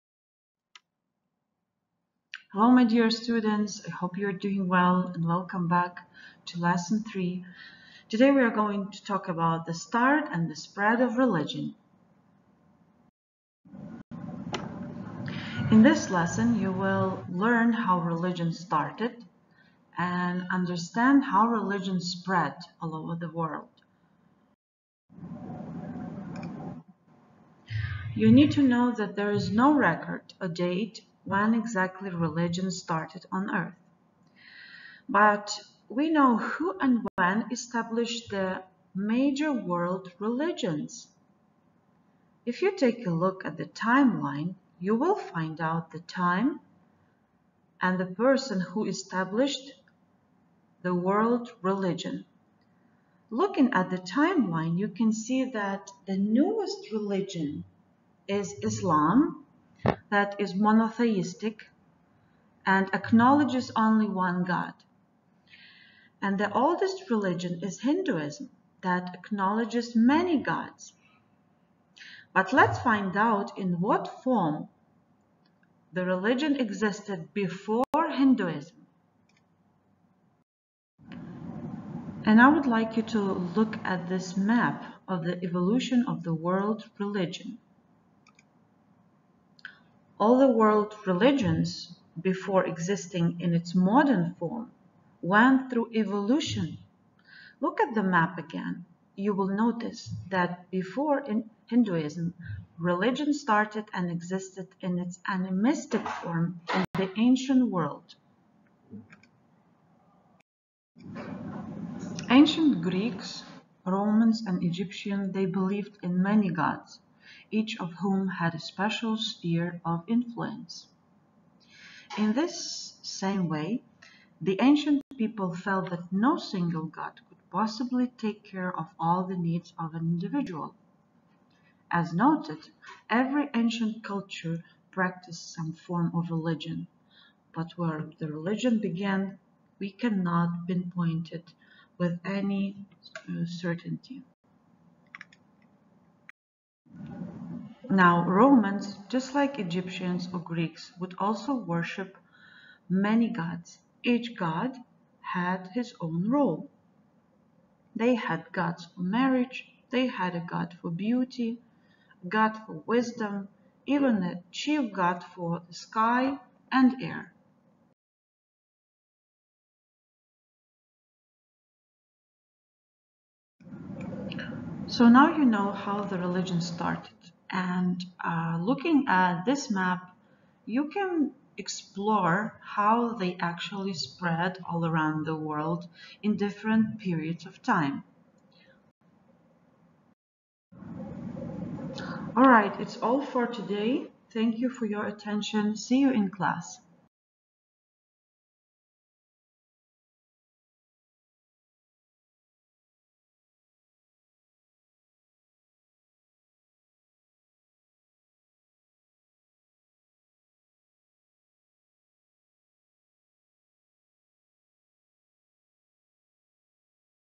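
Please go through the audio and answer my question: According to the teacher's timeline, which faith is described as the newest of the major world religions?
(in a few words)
Islam.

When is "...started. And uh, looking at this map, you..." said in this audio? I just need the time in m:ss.
2:56.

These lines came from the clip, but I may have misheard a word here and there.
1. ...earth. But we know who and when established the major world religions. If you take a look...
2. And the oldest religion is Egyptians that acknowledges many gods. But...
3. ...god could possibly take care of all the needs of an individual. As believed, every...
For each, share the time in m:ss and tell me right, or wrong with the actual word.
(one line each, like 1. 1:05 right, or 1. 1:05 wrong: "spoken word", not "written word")
1. 0:33 right
2. 1:06 wrong: "Hinduism", not "Egyptians"
3. 2:06 wrong: "noted", not "believed".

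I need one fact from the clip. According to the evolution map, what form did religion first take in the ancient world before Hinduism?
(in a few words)
animistic.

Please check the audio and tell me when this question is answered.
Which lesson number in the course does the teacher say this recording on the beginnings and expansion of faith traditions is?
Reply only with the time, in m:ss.
0:06.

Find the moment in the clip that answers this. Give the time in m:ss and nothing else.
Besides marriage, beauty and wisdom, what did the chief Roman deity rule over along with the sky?
2:47.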